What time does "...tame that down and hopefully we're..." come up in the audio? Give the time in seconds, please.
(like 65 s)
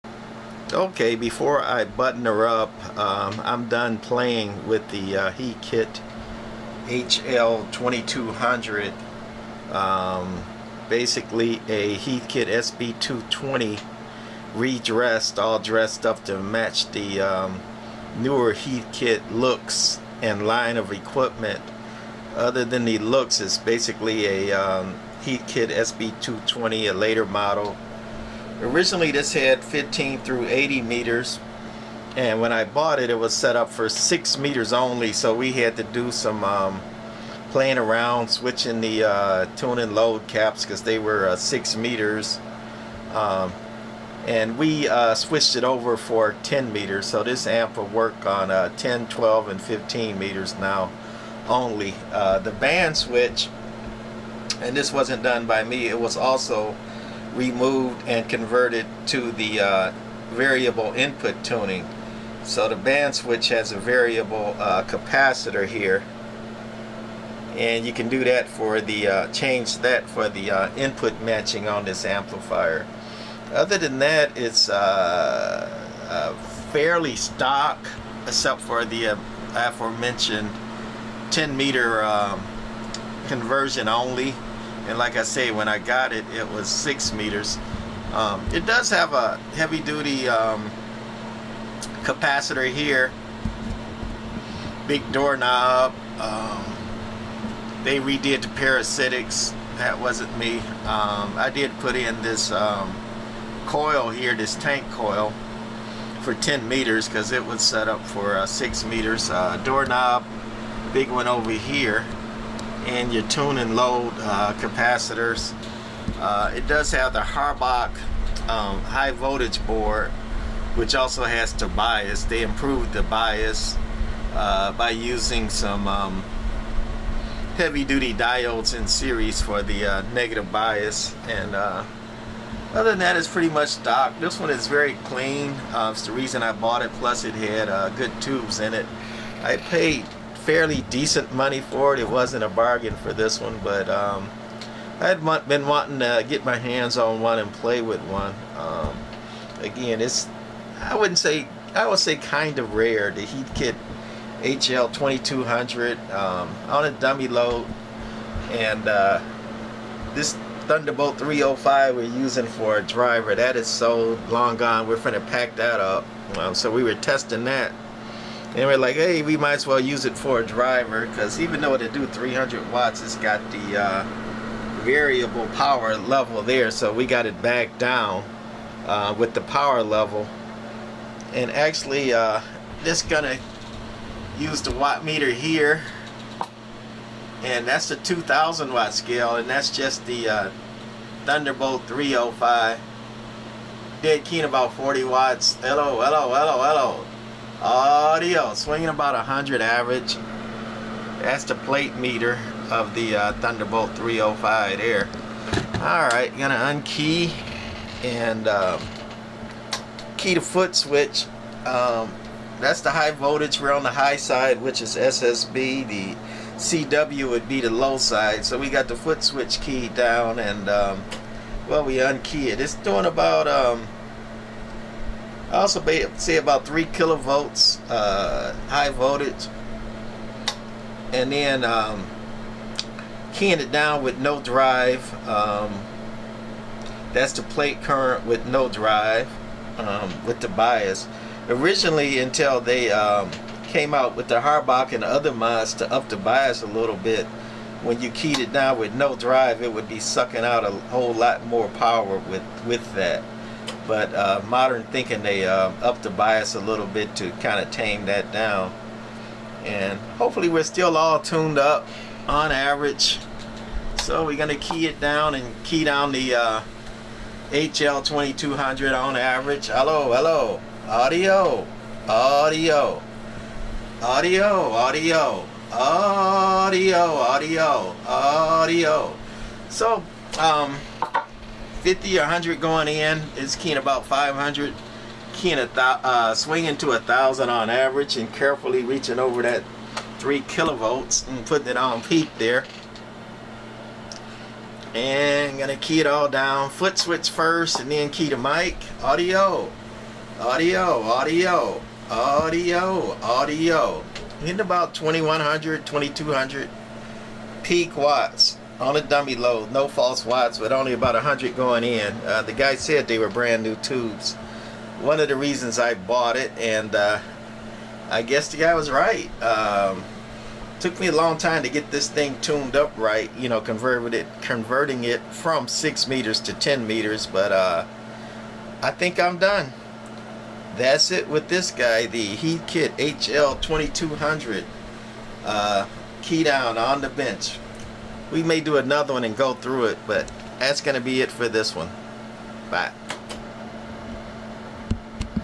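257 s.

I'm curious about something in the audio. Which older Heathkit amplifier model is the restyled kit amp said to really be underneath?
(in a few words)
SB220.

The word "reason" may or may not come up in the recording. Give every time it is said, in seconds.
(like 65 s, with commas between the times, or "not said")
136 s, 315 s.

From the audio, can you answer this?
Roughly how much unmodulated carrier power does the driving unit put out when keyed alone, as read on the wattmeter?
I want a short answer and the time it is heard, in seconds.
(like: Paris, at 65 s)
40 watts, at 194 s.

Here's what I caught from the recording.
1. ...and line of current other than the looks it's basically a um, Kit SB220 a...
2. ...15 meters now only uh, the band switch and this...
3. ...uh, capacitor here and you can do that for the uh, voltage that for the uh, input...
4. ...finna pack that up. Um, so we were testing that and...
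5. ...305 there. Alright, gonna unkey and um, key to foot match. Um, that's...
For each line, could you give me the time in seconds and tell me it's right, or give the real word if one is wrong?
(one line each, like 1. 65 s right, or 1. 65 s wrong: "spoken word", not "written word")
1. 20 s wrong: "equipment", not "current"
2. 49 s right
3. 64 s wrong: "change", not "voltage"
4. 164 s right
5. 203 s wrong: "switch", not "match".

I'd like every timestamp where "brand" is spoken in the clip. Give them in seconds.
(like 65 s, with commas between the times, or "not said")
313 s.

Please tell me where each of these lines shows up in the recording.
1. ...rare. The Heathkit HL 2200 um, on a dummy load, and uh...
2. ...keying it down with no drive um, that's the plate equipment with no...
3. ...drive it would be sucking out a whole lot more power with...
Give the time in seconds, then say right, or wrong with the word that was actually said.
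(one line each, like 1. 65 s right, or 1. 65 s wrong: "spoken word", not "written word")
1. 152 s right
2. 233 s wrong: "current", not "equipment"
3. 249 s right.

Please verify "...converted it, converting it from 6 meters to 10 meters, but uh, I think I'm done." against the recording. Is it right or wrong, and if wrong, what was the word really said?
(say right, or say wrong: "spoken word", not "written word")
right.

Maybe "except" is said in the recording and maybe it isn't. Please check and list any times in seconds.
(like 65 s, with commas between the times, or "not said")
78 s.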